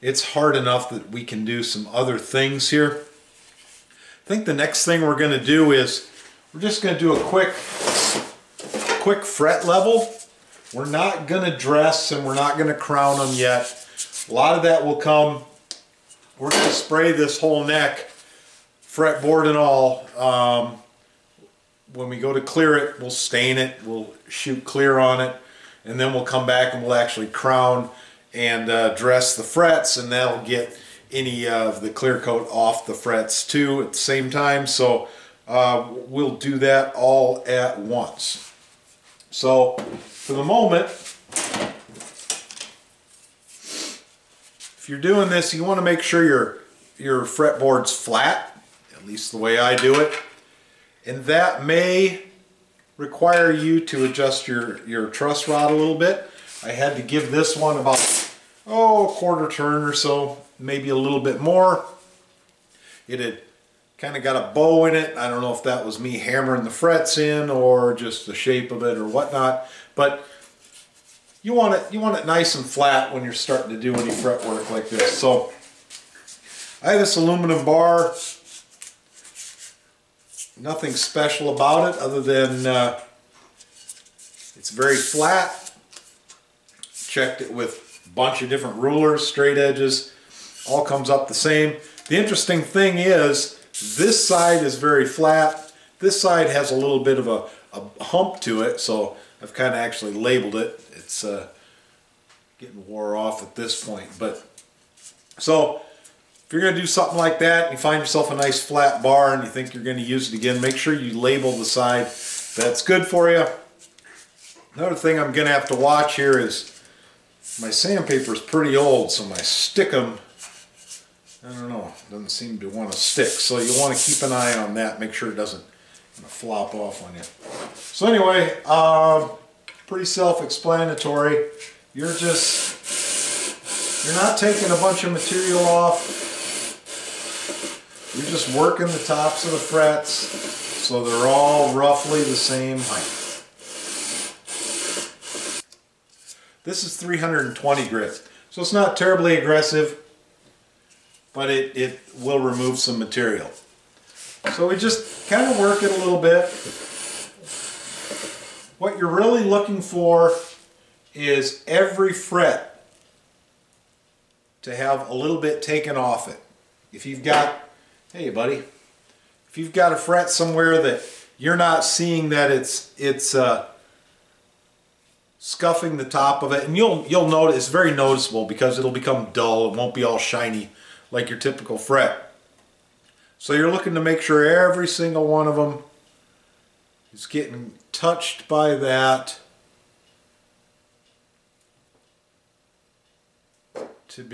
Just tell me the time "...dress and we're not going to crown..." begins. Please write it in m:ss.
0:11.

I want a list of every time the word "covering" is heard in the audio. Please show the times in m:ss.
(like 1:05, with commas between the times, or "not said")
not said.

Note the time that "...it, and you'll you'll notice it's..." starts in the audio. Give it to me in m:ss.
2:56.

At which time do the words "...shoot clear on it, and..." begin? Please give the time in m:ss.
0:24.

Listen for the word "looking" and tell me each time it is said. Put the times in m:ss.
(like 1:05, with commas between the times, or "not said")
2:39, 3:03.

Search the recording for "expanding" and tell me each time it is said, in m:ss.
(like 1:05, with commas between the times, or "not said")
not said.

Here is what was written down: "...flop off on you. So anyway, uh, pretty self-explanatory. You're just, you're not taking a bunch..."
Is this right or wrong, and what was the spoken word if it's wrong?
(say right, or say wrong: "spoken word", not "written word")
right.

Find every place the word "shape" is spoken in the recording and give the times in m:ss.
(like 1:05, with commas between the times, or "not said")
1:08.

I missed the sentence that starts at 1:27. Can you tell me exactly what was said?
Checked it with a bunch of different rulers, straight edges all comes up the same.